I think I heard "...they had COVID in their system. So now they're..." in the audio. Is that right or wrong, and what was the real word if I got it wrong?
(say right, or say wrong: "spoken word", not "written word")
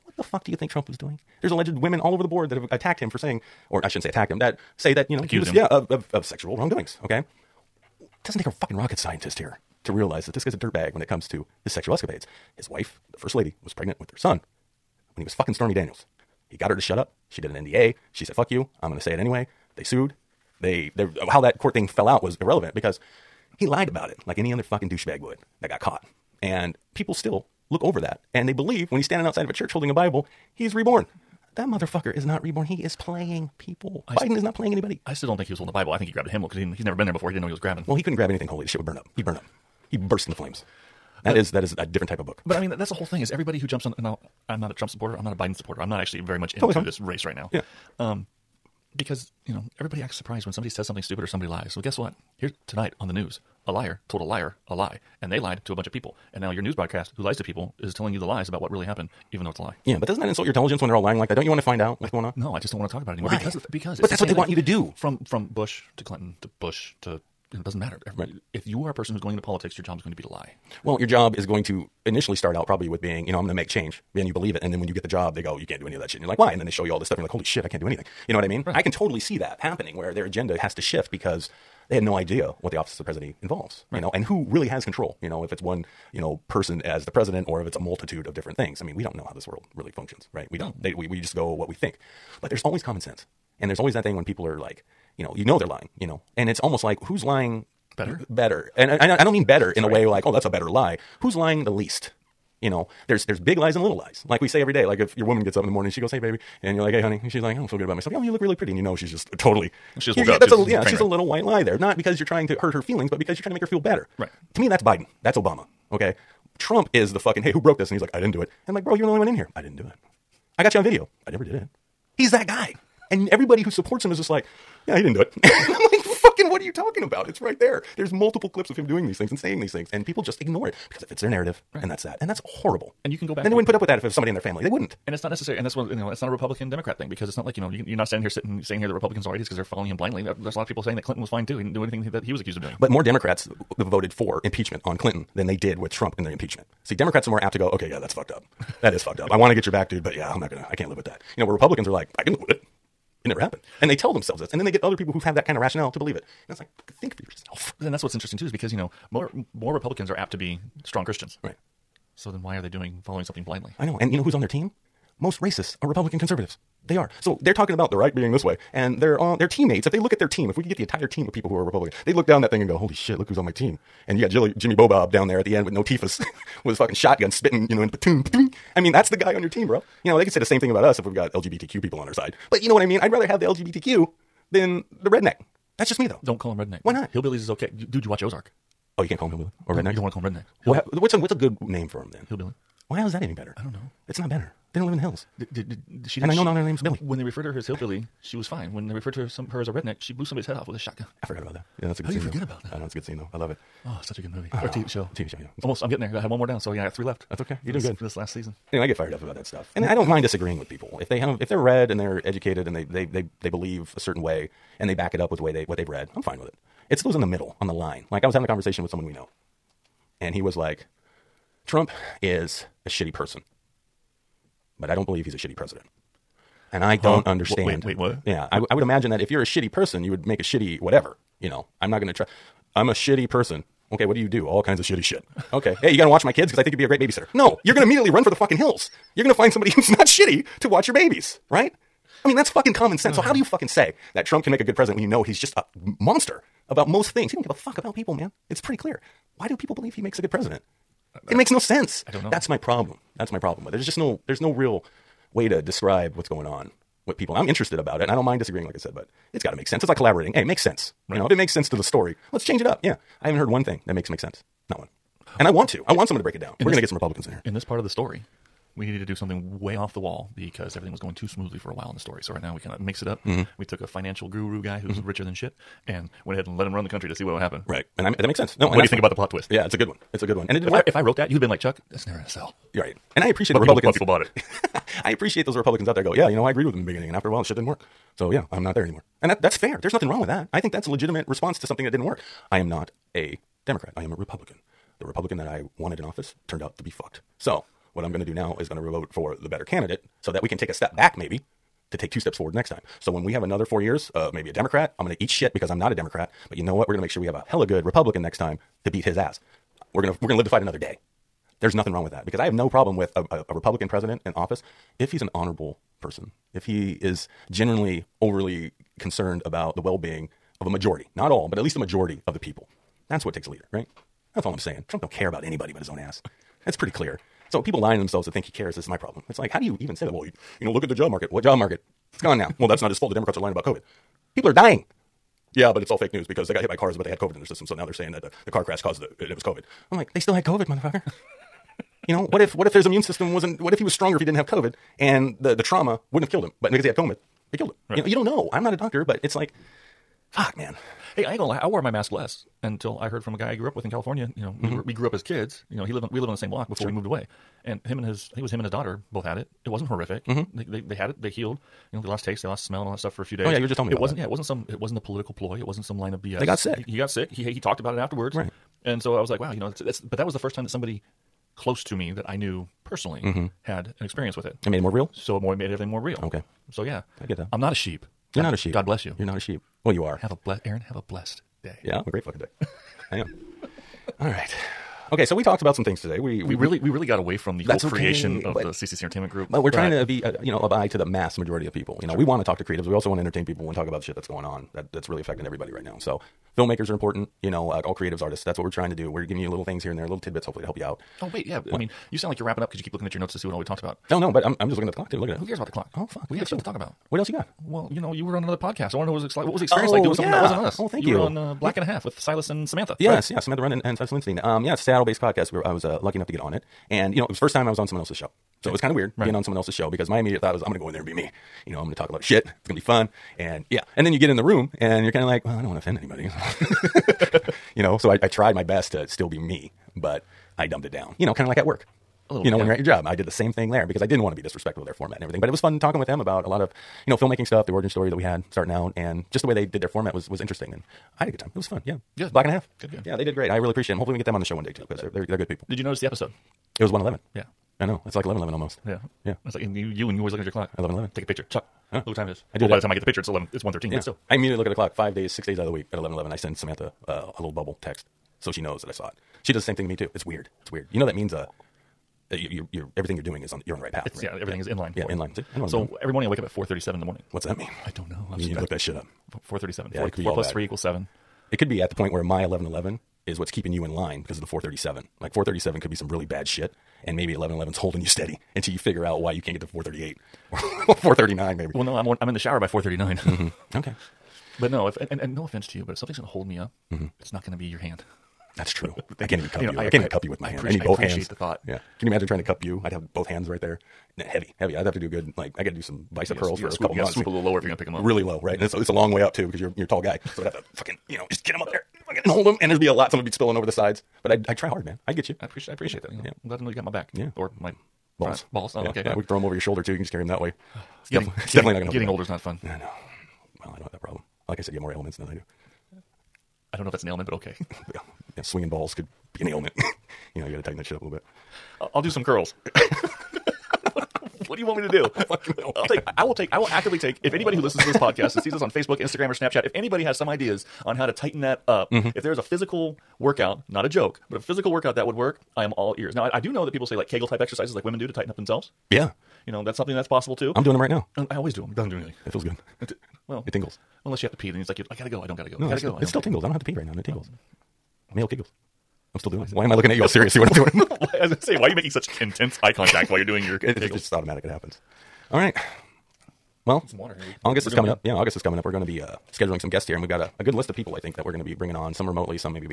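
right.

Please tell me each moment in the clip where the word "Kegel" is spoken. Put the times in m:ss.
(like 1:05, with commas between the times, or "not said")
8:57, 9:08.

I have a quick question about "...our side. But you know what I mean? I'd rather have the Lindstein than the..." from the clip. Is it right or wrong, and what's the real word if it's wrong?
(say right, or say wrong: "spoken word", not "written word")
wrong: "LGBTQ", not "Lindstein".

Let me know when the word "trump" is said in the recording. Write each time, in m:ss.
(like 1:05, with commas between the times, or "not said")
0:00, 0:44, 1:56, 2:25, 3:41, 4:04, 5:24.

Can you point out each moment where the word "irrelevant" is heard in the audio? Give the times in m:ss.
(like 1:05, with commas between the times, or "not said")
0:22.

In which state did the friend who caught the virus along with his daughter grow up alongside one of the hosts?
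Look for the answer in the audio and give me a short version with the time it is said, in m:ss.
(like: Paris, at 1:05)
California, at 5:53.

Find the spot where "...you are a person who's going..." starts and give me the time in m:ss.
1:08.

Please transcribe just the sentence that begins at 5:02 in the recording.
So when we have another four years of maybe a Democrat, I'm going to eat shit because I'm not a Democrat.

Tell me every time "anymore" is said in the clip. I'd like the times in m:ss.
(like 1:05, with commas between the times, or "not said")
1:03, 4:48.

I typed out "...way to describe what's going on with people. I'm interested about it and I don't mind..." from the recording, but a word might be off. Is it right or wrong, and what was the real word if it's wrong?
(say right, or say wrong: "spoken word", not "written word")
right.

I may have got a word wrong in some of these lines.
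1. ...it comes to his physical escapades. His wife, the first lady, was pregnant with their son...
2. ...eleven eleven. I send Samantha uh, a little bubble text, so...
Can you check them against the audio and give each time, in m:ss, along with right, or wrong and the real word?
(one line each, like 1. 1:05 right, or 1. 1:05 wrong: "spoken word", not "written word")
1. 0:11 wrong: "sexual", not "physical"
2. 7:35 right.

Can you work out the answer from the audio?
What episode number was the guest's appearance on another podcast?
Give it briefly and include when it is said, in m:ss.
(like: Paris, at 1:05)
111, at 7:26.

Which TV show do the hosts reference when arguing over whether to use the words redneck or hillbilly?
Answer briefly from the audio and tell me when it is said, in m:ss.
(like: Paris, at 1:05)
Ozark, at 3:08.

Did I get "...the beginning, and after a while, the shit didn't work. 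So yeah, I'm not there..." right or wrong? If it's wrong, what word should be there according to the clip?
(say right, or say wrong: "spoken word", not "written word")
right.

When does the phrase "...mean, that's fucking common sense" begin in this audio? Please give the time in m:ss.
4:02.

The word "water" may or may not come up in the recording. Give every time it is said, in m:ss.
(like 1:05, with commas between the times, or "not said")
9:16.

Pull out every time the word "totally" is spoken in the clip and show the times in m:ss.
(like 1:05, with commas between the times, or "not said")
0:46, 1:18, 1:49.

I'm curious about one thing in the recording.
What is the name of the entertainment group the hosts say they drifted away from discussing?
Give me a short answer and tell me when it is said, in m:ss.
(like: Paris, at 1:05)
CCC Entertainment Group, at 6:28.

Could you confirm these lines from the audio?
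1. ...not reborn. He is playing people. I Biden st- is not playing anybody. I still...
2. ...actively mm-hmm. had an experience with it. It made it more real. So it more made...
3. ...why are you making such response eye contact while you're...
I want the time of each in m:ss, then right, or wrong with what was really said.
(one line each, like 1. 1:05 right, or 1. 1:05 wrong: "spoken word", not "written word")
1. 0:32 right
2. 6:12 wrong: "personally", not "actively"
3. 9:11 wrong: "intense", not "response".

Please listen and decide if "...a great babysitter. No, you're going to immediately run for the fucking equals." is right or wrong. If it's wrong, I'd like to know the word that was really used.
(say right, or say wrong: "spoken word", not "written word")
wrong: "hills", not "equals".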